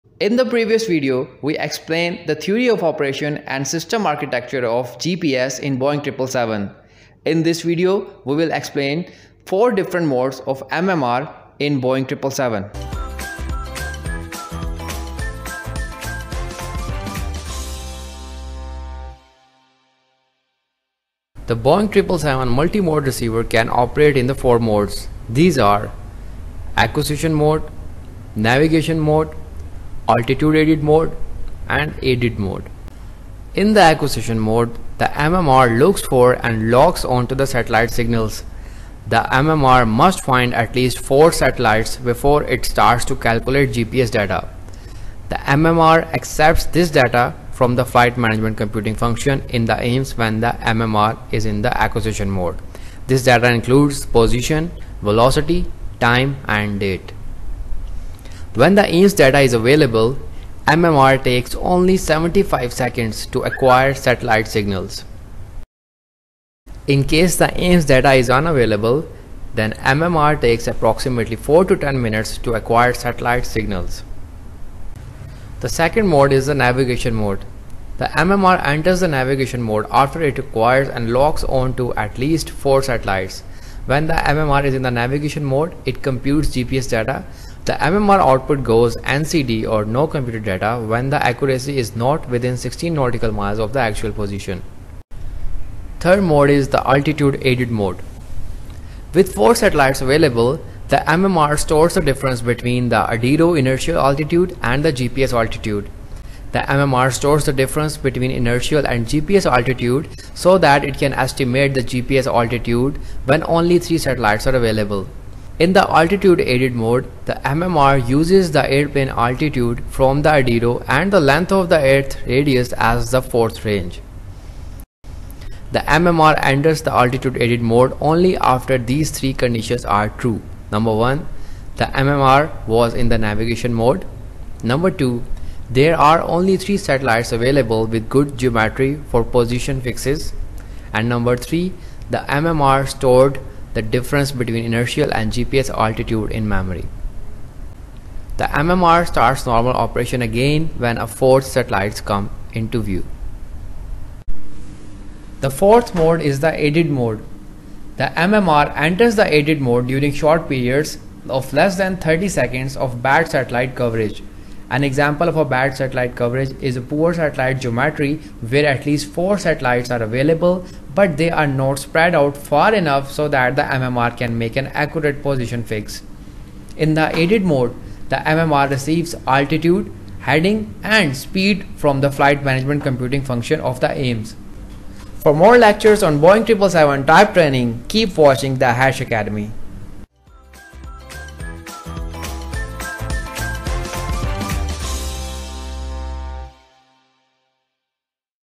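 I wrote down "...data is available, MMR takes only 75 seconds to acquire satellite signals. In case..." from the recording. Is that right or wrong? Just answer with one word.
right.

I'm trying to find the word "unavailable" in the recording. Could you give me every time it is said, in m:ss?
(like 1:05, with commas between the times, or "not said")
1:08.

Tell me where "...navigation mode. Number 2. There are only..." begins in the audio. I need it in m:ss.
2:13.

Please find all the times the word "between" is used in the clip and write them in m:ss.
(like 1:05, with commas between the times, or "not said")
1:42, 1:47, 2:24.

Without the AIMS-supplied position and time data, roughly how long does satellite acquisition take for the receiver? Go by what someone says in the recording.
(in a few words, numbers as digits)
4 to 10 minutes.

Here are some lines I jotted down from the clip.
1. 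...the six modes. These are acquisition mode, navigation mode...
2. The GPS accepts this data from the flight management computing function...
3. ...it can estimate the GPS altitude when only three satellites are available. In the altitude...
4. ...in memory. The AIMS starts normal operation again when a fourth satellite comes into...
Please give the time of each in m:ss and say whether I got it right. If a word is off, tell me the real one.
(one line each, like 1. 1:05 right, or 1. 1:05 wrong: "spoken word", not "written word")
1. 0:24 wrong: "four", not "six"
2. 0:45 wrong: "MMR", not "GPS"
3. 1:50 right
4. 2:26 wrong: "MMR", not "AIMS".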